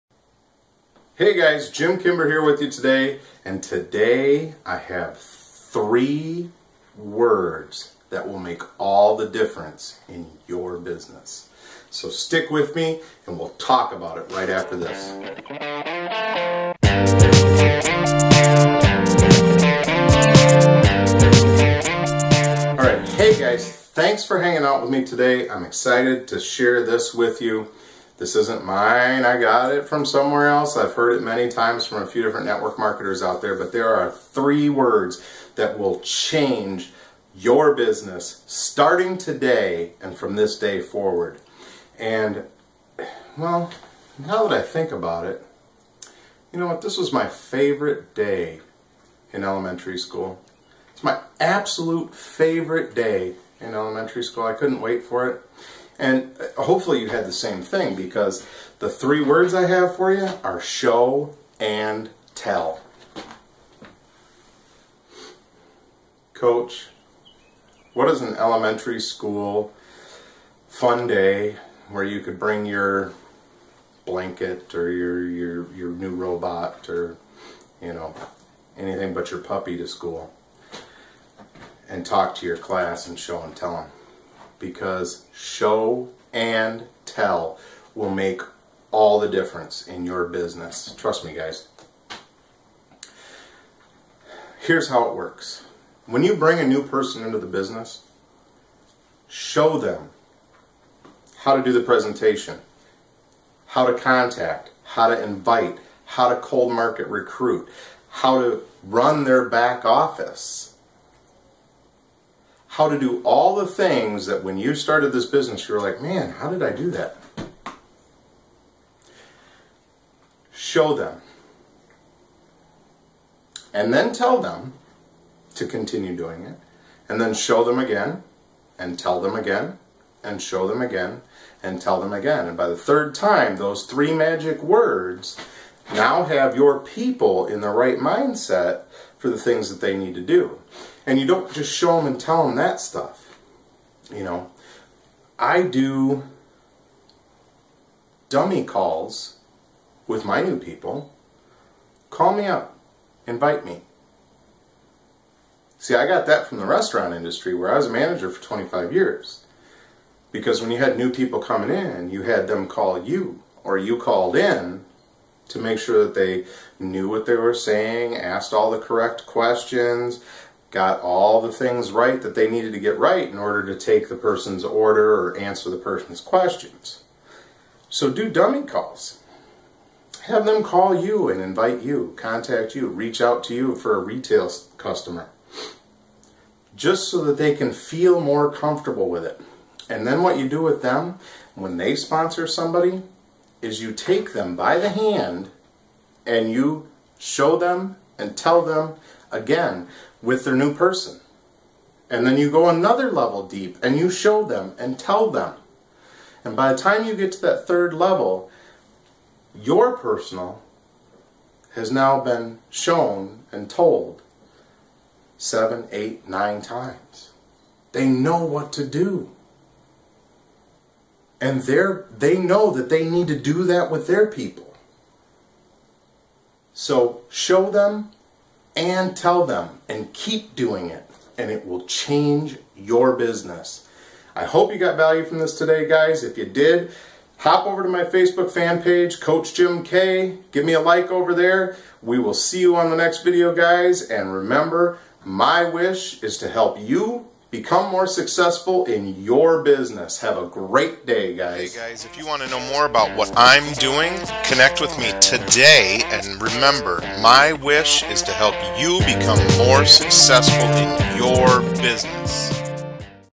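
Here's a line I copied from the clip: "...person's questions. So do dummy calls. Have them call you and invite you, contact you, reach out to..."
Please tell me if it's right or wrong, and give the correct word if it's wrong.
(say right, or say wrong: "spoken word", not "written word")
right.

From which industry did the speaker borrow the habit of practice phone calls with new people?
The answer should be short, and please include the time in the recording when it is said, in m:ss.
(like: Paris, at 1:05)
Restaurant industry, at 2:36.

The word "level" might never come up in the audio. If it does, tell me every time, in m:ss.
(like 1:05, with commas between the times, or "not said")
3:23, 3:27.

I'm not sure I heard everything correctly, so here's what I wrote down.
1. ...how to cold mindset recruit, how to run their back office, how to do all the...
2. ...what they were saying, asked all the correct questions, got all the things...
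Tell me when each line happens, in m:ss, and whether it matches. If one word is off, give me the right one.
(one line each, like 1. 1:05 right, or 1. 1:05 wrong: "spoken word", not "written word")
1. 1:46 wrong: "market", not "mindset"
2. 2:47 right.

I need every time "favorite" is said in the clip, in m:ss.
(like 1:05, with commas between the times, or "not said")
0:47, 0:52.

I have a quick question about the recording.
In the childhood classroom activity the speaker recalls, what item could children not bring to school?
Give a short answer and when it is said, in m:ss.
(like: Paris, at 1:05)
Puppy, at 1:19.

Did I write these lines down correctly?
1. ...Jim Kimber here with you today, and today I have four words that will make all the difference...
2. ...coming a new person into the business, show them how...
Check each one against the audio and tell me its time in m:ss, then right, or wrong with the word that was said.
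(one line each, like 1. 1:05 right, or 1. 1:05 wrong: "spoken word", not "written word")
1. 0:01 wrong: "three", not "four"
2. 1:36 wrong: "bring", not "coming".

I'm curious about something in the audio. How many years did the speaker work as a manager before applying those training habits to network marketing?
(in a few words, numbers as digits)
25.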